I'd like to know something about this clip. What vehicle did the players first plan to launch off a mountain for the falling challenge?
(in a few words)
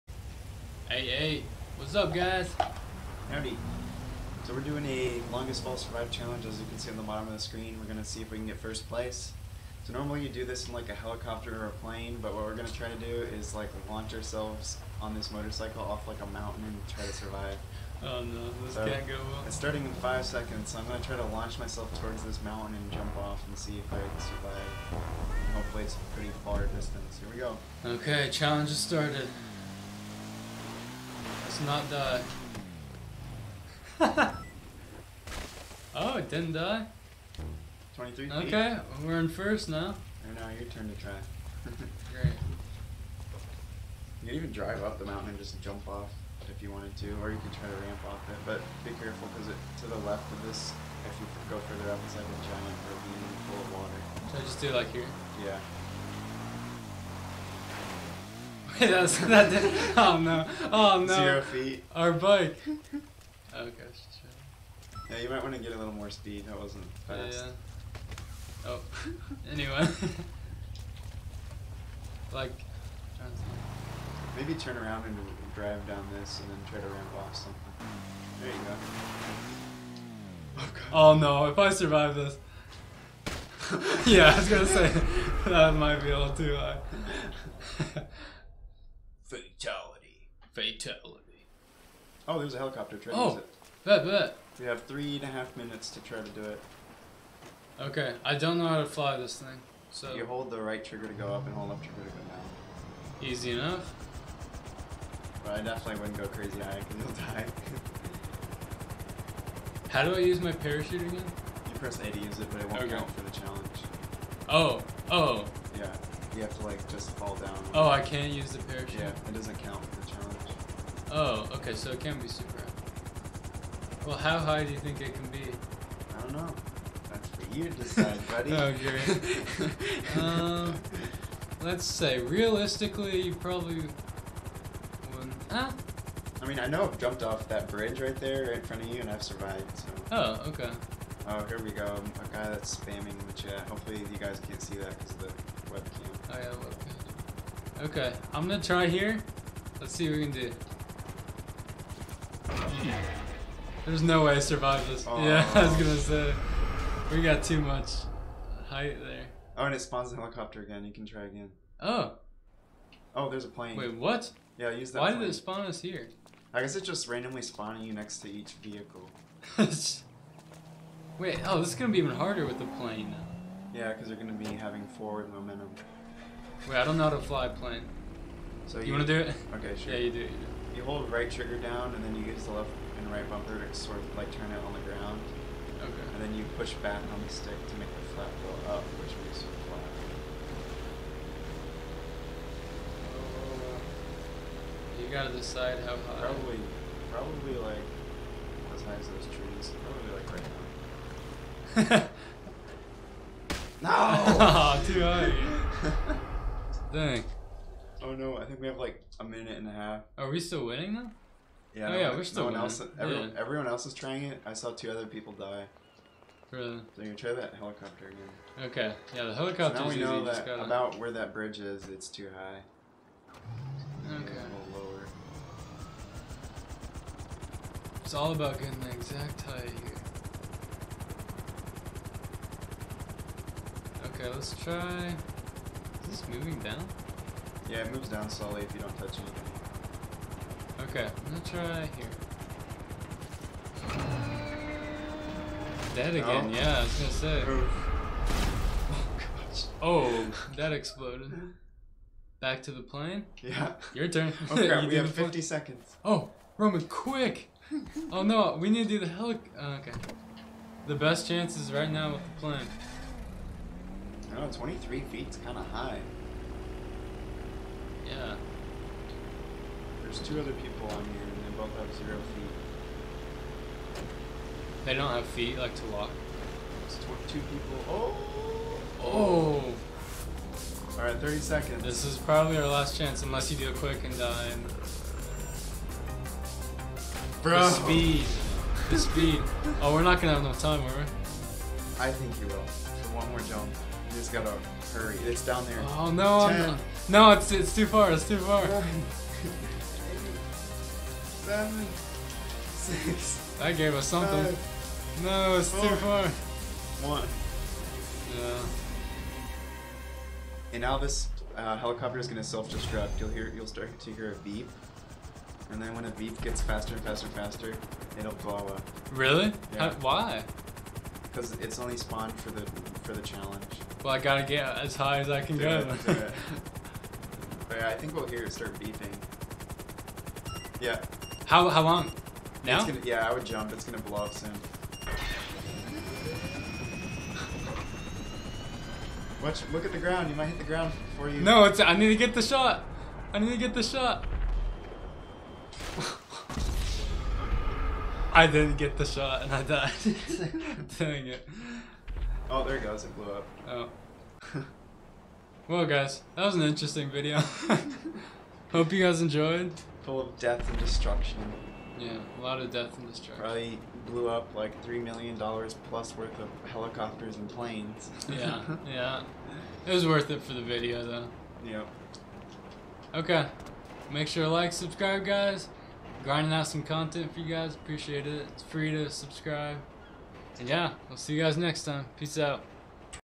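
Motorcycle.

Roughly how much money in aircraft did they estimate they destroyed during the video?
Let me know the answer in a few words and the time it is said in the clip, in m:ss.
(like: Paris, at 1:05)
3 million dollars, at 6:04.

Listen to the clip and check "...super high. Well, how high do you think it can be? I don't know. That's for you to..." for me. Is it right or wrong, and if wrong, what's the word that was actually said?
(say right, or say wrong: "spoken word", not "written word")
right.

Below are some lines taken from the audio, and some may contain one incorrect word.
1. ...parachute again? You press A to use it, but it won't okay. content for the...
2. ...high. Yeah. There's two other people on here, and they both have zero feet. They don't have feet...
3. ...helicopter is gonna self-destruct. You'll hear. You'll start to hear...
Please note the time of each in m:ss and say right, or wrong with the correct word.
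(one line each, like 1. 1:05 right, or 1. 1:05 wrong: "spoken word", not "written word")
1. 1:50 wrong: "count", not "content"
2. 4:25 right
3. 5:11 right.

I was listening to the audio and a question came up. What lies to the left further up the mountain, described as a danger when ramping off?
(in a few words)
Giant ravine full of water.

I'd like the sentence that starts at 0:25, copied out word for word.
hopefully it's a pretty far distance.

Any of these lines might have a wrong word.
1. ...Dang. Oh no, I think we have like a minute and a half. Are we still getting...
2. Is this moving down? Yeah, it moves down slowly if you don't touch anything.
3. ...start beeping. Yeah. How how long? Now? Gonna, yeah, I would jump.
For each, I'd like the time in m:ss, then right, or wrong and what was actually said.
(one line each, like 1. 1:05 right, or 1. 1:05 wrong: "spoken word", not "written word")
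1. 3:26 wrong: "winning", not "getting"
2. 3:55 right
3. 5:28 right.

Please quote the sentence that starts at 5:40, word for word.
You might hit the ground before you.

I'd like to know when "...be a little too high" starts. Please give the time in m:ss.
1:26.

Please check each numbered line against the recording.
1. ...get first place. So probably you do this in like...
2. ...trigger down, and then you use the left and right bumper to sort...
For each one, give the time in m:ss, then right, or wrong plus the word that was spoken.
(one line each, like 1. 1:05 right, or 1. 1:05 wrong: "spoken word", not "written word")
1. 0:08 wrong: "normally", not "probably"
2. 3:01 right.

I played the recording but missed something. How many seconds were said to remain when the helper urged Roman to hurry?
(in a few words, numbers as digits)
50.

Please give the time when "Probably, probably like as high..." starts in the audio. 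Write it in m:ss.
3:16.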